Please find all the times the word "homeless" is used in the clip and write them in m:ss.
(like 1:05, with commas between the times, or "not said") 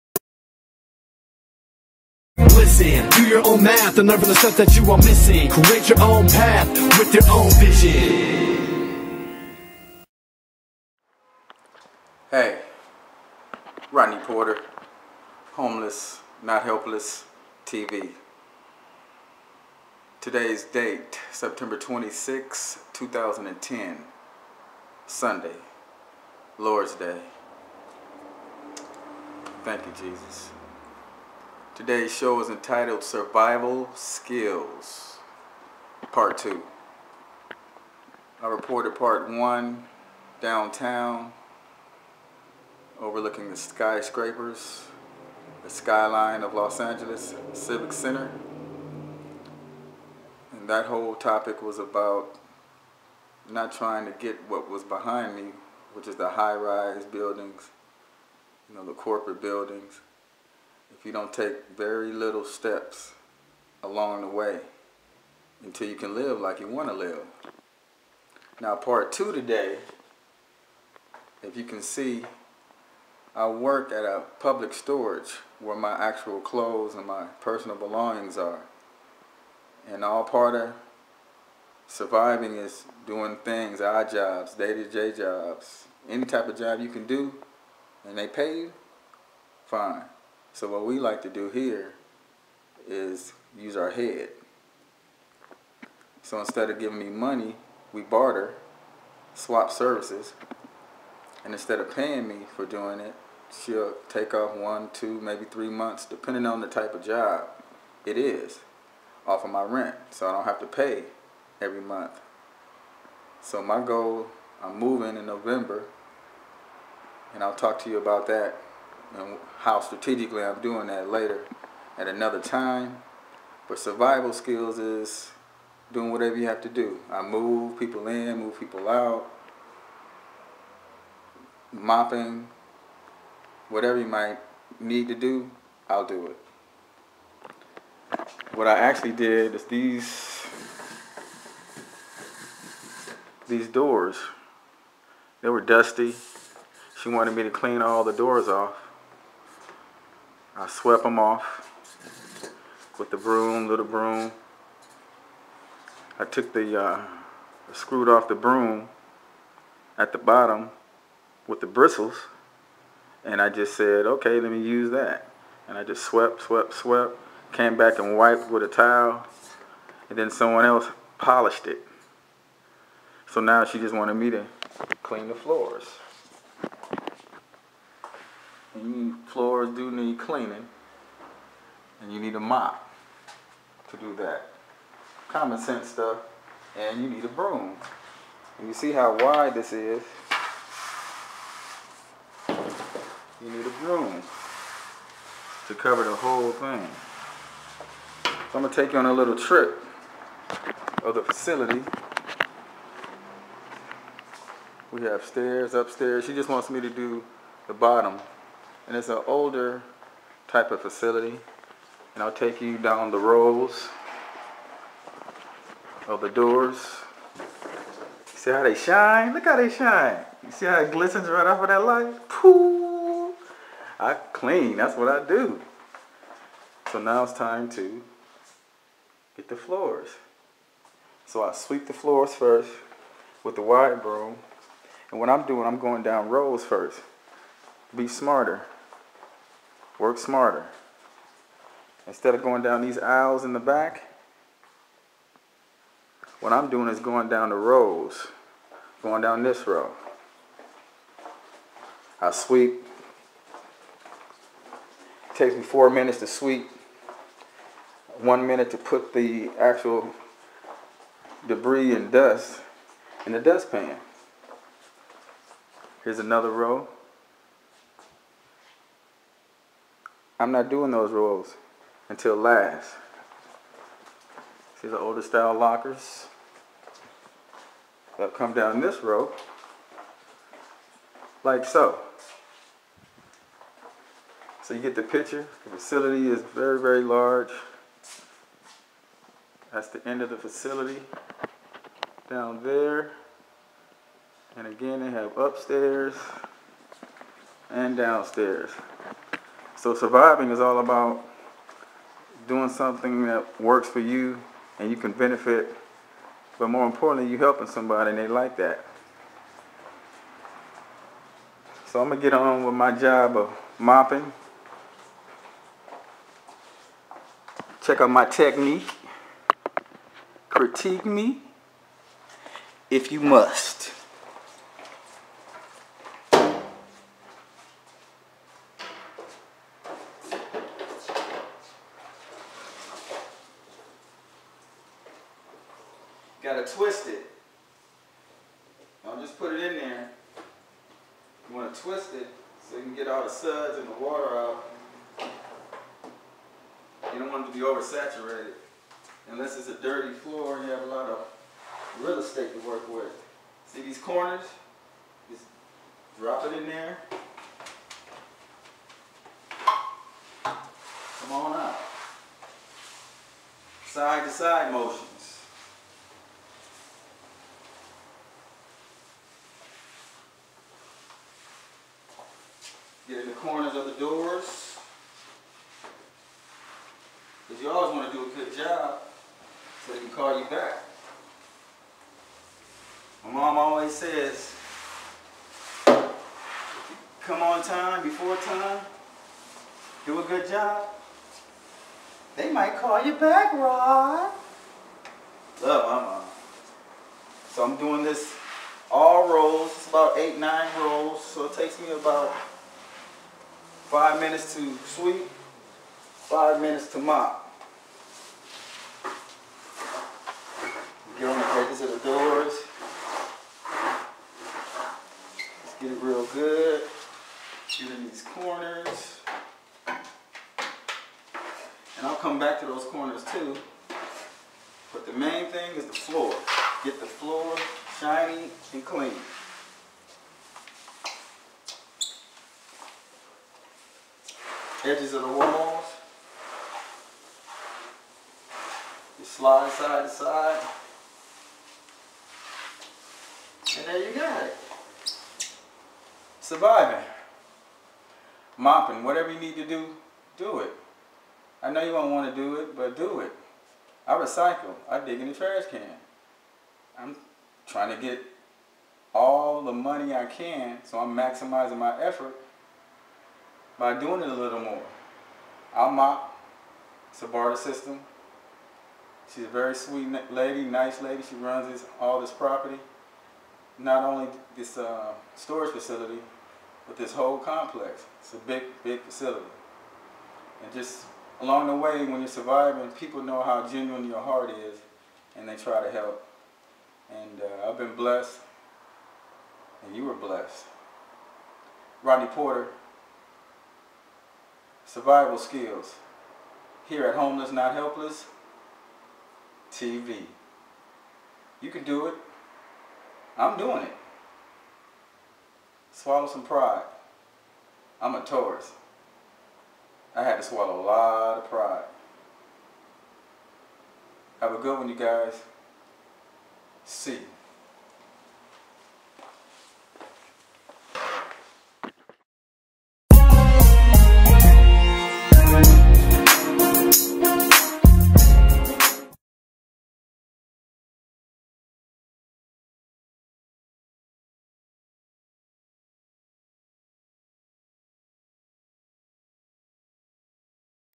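0:15, 8:17.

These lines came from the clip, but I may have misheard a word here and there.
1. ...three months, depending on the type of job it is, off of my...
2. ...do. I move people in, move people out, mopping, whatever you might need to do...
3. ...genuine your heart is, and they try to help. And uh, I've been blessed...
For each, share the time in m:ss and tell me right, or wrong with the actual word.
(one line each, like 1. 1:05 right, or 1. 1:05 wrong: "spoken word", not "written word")
1. 1:45 right
2. 2:06 right
3. 8:03 right.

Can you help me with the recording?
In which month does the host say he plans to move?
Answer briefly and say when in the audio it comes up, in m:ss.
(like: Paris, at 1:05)
November, at 1:55.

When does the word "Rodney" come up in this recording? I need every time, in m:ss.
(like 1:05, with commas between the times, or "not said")
0:13, 8:12.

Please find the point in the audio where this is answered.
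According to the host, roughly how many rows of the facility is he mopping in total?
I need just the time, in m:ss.
6:40.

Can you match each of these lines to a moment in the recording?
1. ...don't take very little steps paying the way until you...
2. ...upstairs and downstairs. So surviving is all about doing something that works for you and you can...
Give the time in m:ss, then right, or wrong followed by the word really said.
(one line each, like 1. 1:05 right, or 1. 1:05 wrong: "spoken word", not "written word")
1. 1:01 wrong: "along", not "paying"
2. 4:55 right.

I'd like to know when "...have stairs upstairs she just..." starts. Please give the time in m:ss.
3:25.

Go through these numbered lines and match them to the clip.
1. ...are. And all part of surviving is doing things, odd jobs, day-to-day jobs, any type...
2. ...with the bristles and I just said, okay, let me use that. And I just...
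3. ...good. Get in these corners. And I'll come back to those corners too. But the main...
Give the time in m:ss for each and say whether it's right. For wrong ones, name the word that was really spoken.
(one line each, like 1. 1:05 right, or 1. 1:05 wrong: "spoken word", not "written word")
1. 1:18 right
2. 2:41 right
3. 6:56 right.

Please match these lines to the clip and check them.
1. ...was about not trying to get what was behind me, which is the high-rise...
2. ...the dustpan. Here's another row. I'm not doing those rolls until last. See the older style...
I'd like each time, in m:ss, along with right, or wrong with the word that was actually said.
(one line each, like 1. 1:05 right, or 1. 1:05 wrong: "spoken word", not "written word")
1. 0:51 right
2. 4:23 right.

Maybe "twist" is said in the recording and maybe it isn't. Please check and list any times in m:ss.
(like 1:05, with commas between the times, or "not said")
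5:36, 5:41.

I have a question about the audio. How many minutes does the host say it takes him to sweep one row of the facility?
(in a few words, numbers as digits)
4.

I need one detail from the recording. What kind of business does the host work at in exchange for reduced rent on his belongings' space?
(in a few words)
public storage.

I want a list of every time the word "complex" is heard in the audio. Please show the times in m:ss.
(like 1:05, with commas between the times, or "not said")
7:57.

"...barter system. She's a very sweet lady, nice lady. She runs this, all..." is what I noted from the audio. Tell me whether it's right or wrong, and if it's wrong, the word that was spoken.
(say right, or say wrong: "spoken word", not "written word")
right.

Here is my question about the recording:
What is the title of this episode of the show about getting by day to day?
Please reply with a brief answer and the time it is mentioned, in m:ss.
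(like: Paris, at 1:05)
Survival Skills, Part 2, at 0:33.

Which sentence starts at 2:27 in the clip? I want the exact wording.
She wanted me to clean all the doors off.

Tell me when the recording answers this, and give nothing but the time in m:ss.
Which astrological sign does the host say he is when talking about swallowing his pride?
8:28.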